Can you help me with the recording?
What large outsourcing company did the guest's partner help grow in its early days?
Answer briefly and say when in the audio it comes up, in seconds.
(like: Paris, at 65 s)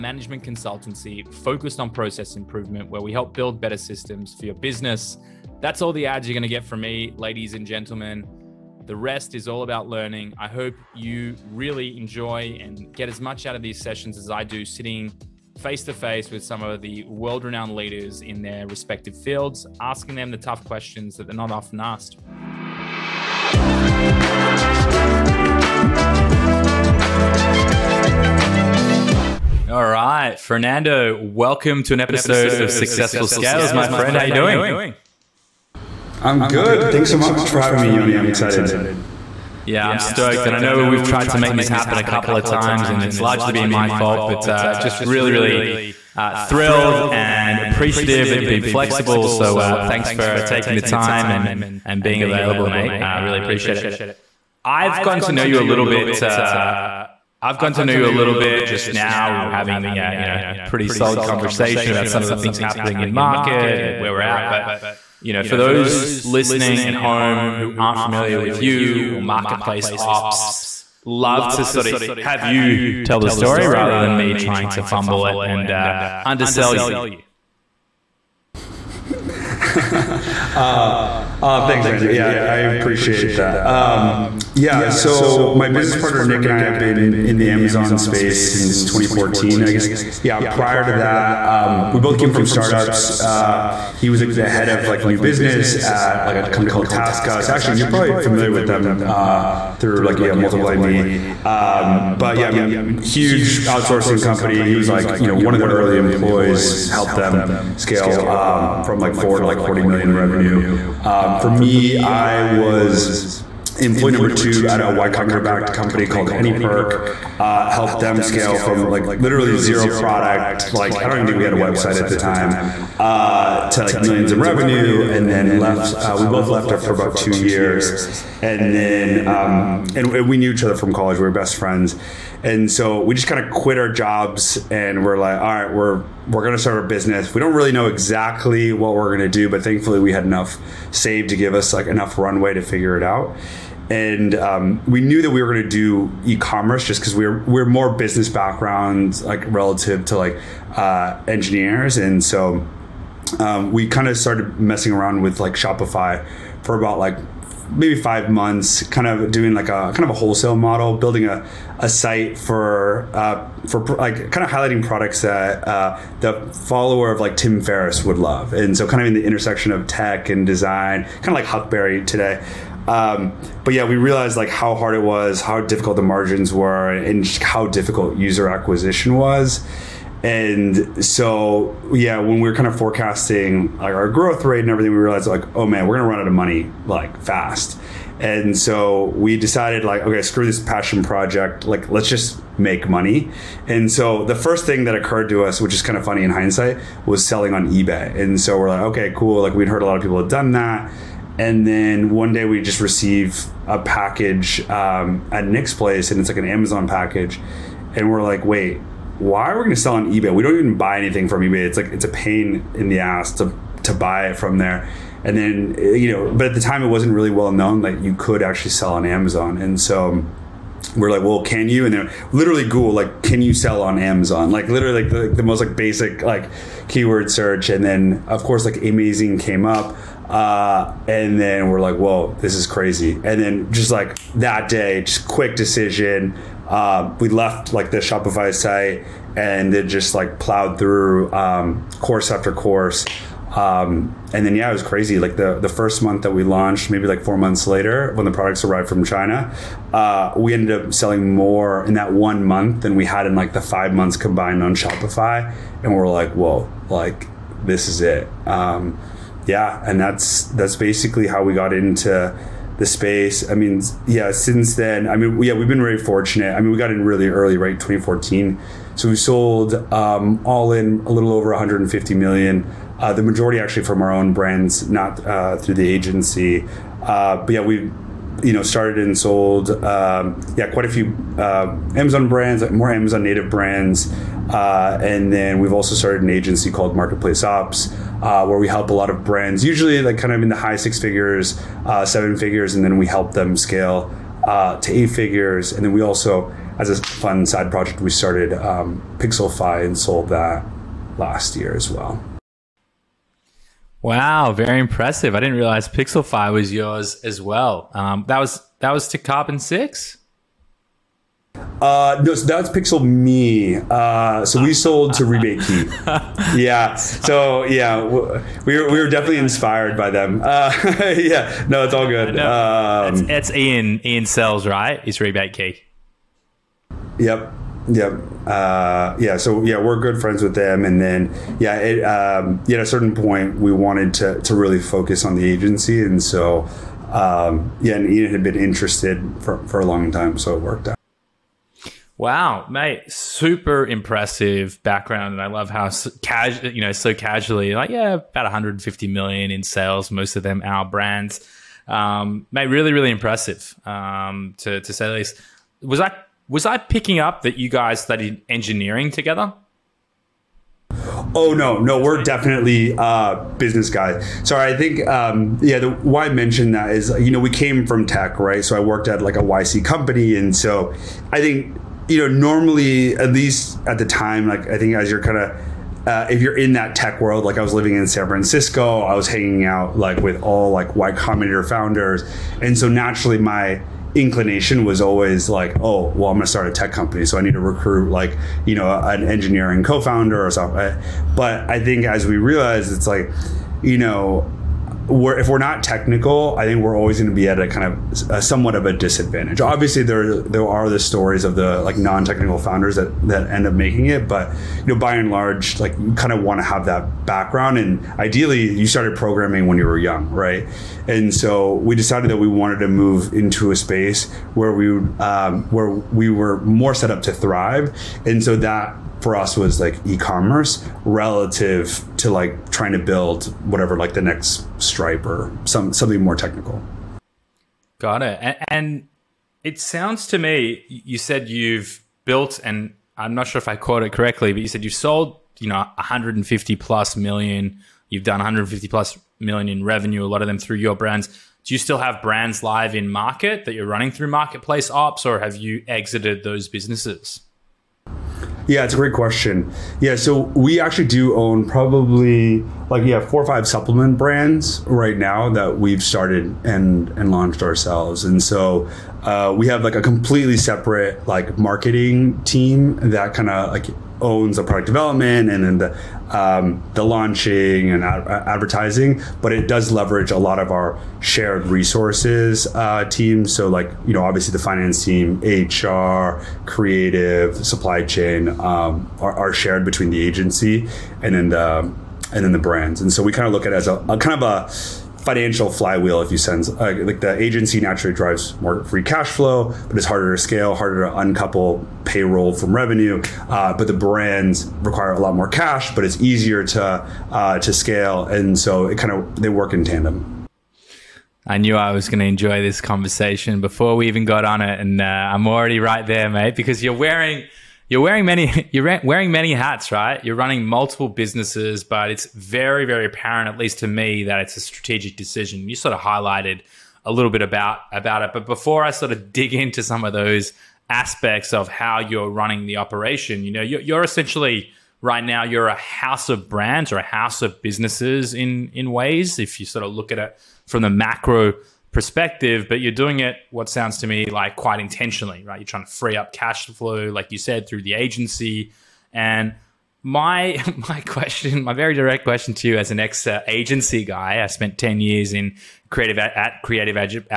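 TaskUs, at 96 s.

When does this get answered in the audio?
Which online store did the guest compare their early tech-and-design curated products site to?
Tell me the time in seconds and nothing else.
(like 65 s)
171 s.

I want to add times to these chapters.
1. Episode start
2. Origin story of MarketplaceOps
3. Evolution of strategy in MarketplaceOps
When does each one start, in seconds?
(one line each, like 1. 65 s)
1. 28 s
2. 92 s
3. 499 s.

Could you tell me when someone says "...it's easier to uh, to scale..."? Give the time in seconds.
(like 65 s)
496 s.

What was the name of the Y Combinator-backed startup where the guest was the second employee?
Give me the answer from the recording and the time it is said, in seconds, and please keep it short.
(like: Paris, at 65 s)
AnyPerk, at 116 s.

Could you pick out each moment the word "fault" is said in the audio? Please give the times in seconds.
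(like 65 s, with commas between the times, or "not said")
43 s.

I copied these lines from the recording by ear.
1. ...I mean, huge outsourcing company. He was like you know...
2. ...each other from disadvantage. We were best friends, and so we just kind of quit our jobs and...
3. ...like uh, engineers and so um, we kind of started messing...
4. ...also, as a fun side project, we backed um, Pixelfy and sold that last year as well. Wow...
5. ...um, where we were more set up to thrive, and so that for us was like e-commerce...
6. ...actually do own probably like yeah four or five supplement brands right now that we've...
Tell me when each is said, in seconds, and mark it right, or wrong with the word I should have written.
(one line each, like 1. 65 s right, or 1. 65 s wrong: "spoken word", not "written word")
1. 102 s right
2. 130 s wrong: "college", not "disadvantage"
3. 150 s right
4. 296 s wrong: "started", not "backed"
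5. 415 s right
6. 450 s right.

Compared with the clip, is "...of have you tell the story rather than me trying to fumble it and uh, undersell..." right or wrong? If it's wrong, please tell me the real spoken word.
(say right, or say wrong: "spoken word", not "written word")
right.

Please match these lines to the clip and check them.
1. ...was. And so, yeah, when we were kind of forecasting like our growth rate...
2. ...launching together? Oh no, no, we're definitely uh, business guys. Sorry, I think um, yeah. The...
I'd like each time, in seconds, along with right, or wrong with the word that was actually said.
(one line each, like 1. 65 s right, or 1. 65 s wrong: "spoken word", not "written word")
1. 179 s right
2. 358 s wrong: "engineering", not "launching".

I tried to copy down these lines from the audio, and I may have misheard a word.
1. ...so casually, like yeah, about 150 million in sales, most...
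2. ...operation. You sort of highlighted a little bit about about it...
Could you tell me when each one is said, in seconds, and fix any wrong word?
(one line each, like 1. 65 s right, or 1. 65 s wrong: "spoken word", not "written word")
1. 346 s right
2. 515 s wrong: "decision", not "operation".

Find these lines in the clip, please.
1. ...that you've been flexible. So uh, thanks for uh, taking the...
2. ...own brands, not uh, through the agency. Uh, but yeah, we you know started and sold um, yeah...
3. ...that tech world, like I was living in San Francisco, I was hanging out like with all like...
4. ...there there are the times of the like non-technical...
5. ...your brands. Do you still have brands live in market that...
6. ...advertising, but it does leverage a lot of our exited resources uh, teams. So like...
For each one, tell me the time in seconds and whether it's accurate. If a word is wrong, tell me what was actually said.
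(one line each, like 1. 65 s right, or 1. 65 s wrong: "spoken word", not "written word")
1. 48 s right
2. 274 s right
3. 376 s right
4. 400 s wrong: "stories", not "times"
5. 440 s right
6. 468 s wrong: "shared", not "exited".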